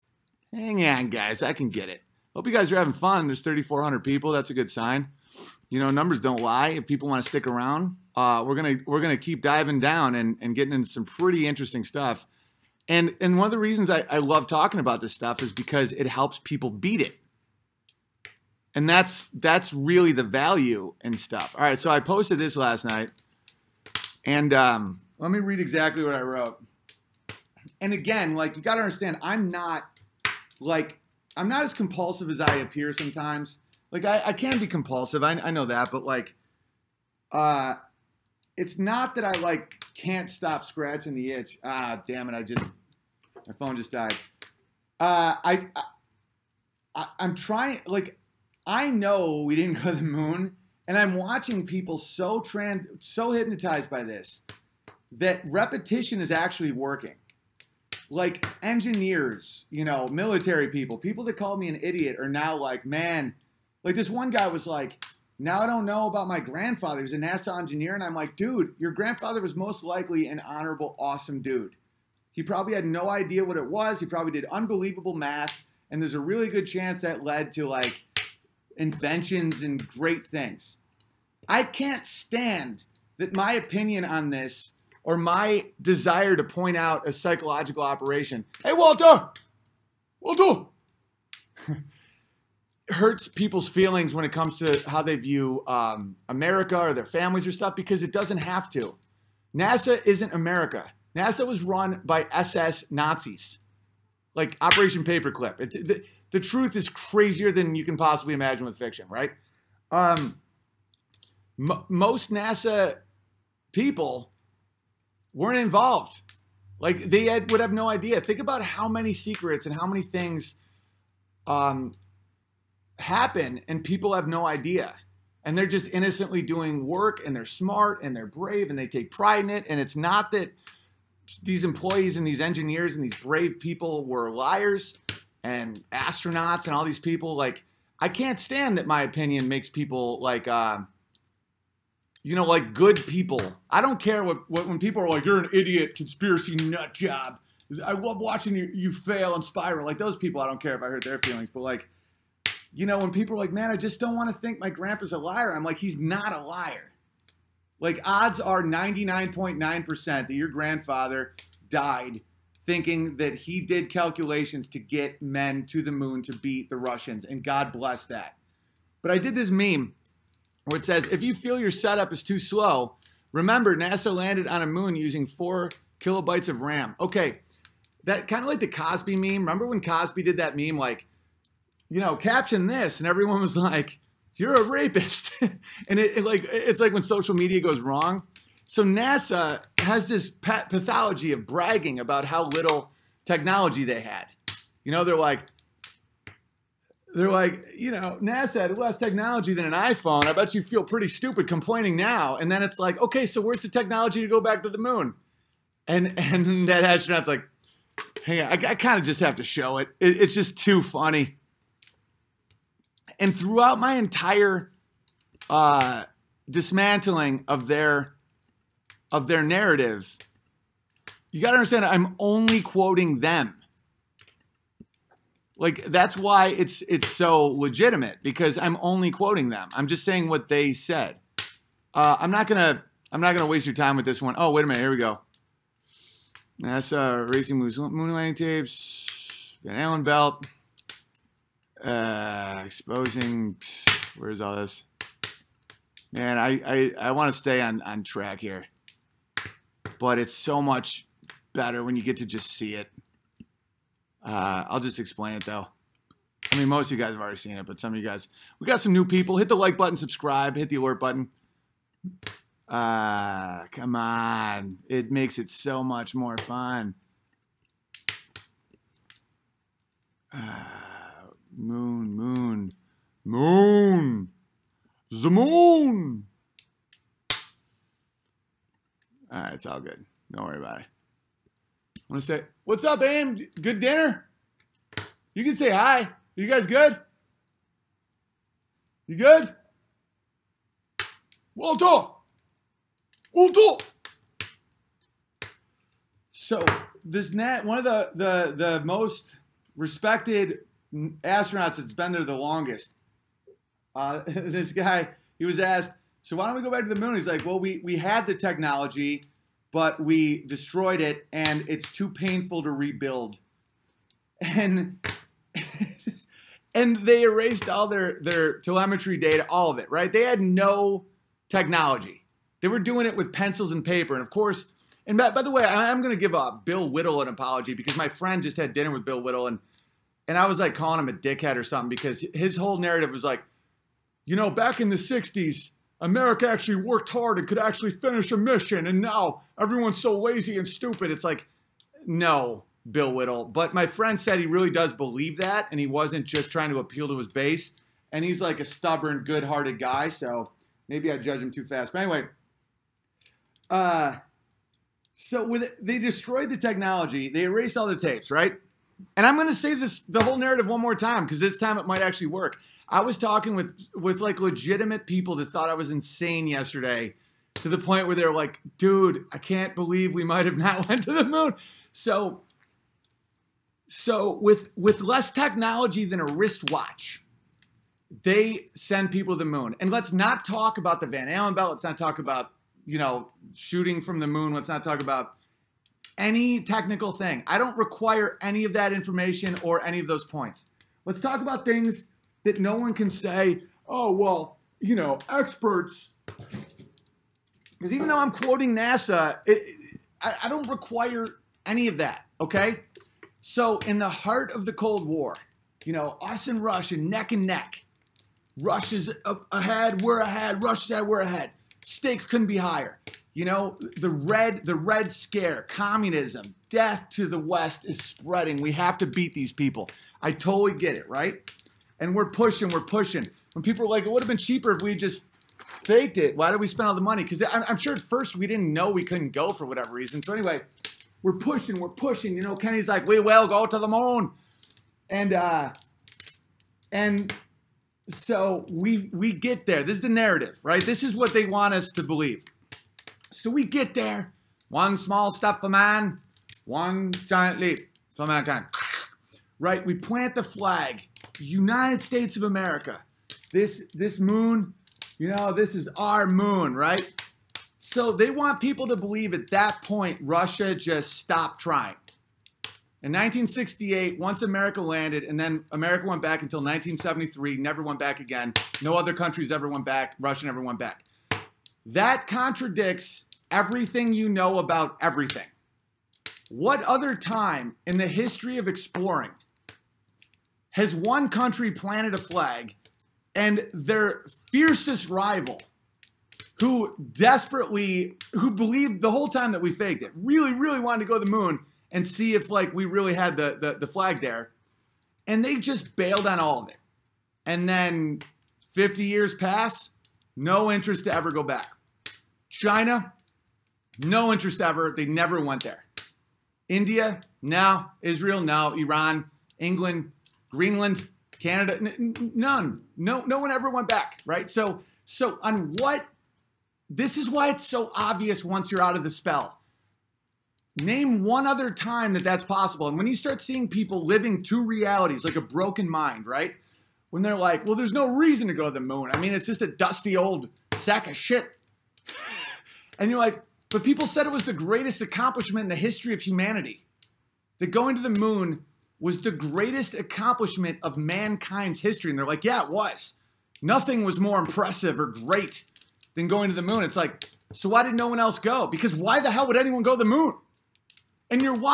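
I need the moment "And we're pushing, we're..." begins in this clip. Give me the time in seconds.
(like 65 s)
421 s.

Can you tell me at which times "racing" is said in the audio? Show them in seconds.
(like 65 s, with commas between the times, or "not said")
237 s.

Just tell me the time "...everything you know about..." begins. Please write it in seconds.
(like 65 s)
473 s.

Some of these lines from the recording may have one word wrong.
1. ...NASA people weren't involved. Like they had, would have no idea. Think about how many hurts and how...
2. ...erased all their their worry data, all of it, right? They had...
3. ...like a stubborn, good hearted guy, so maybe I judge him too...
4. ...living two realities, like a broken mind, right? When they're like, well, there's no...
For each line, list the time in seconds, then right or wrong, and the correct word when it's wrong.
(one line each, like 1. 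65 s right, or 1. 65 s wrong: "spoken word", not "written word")
1. 112 s wrong: "secrets", not "hurts"
2. 317 s wrong: "telemetry", not "worry"
3. 348 s right
4. 524 s right.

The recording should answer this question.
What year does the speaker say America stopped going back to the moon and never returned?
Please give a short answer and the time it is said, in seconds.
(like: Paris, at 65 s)
1973, at 466 s.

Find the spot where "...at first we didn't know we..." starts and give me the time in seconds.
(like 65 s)
427 s.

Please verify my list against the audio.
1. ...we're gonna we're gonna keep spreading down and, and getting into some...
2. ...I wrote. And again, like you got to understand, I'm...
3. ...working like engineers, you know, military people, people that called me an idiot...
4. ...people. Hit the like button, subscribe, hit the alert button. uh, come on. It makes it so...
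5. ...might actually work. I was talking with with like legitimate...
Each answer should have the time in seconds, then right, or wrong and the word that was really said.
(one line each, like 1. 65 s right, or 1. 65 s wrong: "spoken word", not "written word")
1. 8 s wrong: "diving", not "spreading"
2. 26 s right
3. 56 s right
4. 259 s right
5. 361 s right.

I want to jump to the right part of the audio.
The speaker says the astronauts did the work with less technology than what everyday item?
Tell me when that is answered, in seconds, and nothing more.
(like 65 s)
376 s.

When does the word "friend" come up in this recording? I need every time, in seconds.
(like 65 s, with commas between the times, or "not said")
328 s, 343 s.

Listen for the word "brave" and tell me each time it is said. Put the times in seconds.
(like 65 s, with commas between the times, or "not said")
128 s, 133 s.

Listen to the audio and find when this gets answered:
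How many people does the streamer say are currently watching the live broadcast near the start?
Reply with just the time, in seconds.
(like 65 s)
3 s.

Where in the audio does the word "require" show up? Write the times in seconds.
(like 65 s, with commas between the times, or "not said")
387 s, 400 s.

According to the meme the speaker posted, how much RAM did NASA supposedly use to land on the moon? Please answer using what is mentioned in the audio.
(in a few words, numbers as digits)
4 kilobytes.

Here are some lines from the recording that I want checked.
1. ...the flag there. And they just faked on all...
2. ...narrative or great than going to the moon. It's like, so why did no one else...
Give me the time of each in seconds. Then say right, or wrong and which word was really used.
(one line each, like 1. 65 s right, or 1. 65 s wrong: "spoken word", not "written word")
1. 493 s wrong: "bailed", not "faked"
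2. 544 s wrong: "impressive", not "narrative".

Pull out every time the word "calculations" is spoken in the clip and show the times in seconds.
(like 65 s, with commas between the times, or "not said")
163 s.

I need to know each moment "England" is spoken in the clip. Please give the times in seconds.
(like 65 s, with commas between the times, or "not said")
509 s.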